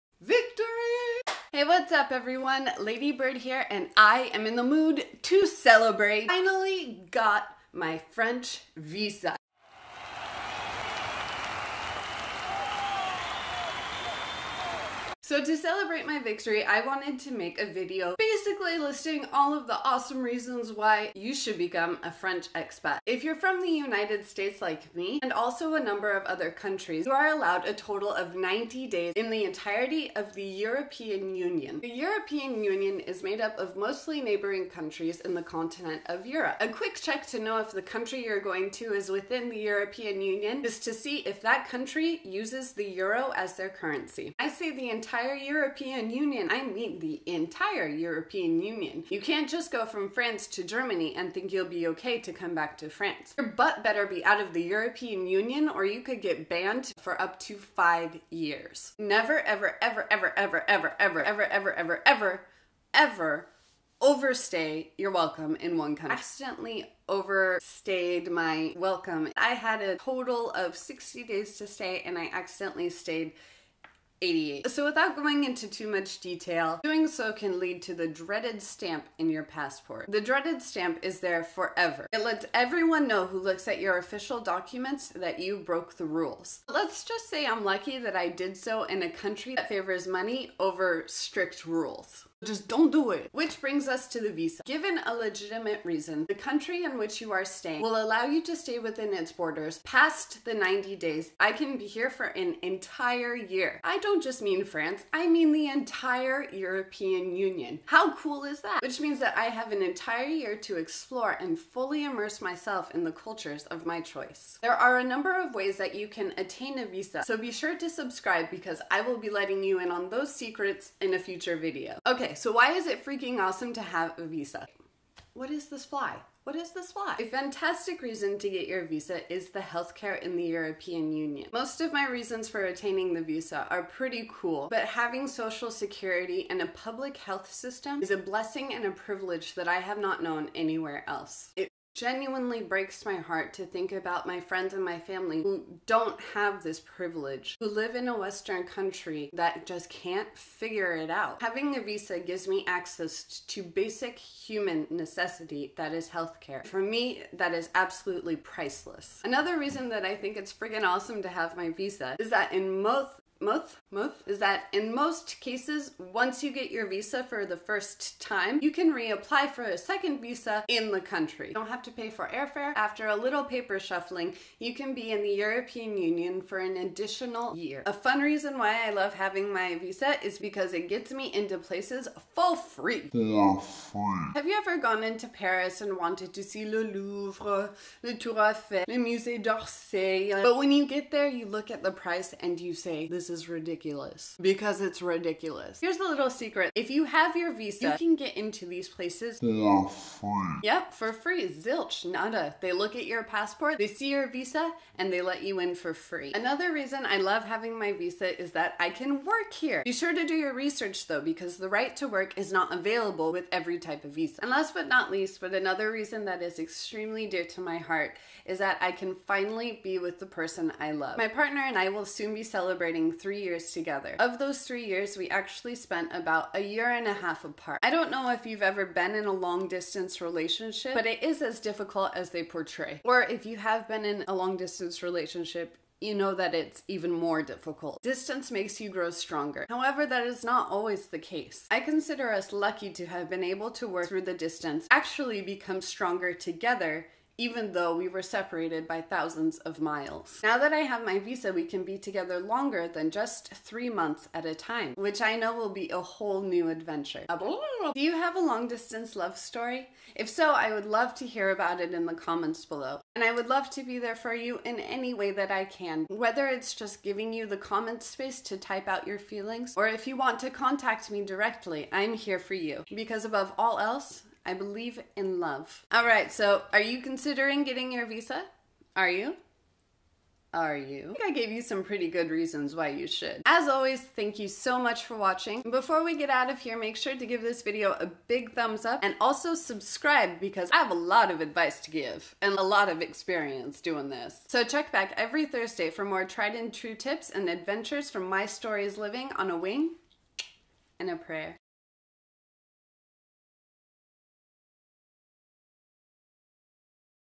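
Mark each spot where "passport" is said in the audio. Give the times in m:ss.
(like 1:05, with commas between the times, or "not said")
1:19, 3:23.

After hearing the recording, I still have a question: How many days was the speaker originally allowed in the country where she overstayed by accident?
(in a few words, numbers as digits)
60.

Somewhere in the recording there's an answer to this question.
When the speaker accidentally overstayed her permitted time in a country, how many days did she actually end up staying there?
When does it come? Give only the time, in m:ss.
1:14.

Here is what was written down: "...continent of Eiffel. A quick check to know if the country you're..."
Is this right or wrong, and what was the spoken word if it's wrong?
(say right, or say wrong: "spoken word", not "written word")
wrong: "Europe", not "Eiffel".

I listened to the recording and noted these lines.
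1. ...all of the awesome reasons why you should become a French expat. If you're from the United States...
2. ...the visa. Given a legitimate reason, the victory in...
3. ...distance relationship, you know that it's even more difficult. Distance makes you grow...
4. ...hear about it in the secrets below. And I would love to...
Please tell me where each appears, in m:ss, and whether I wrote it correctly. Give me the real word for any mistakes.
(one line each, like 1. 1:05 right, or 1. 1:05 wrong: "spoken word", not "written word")
1. 0:19 right
2. 1:34 wrong: "country", not "victory"
3. 3:54 right
4. 4:21 wrong: "comments", not "secrets".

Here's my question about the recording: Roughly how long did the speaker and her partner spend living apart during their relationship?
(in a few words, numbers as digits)
a year and a half.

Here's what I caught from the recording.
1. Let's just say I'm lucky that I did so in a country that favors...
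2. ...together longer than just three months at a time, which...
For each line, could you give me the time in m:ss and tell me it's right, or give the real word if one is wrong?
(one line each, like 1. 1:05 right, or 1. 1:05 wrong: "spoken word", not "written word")
1. 1:26 right
2. 4:11 right.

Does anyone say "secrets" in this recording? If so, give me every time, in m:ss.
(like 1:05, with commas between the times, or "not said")
2:00, 3:16.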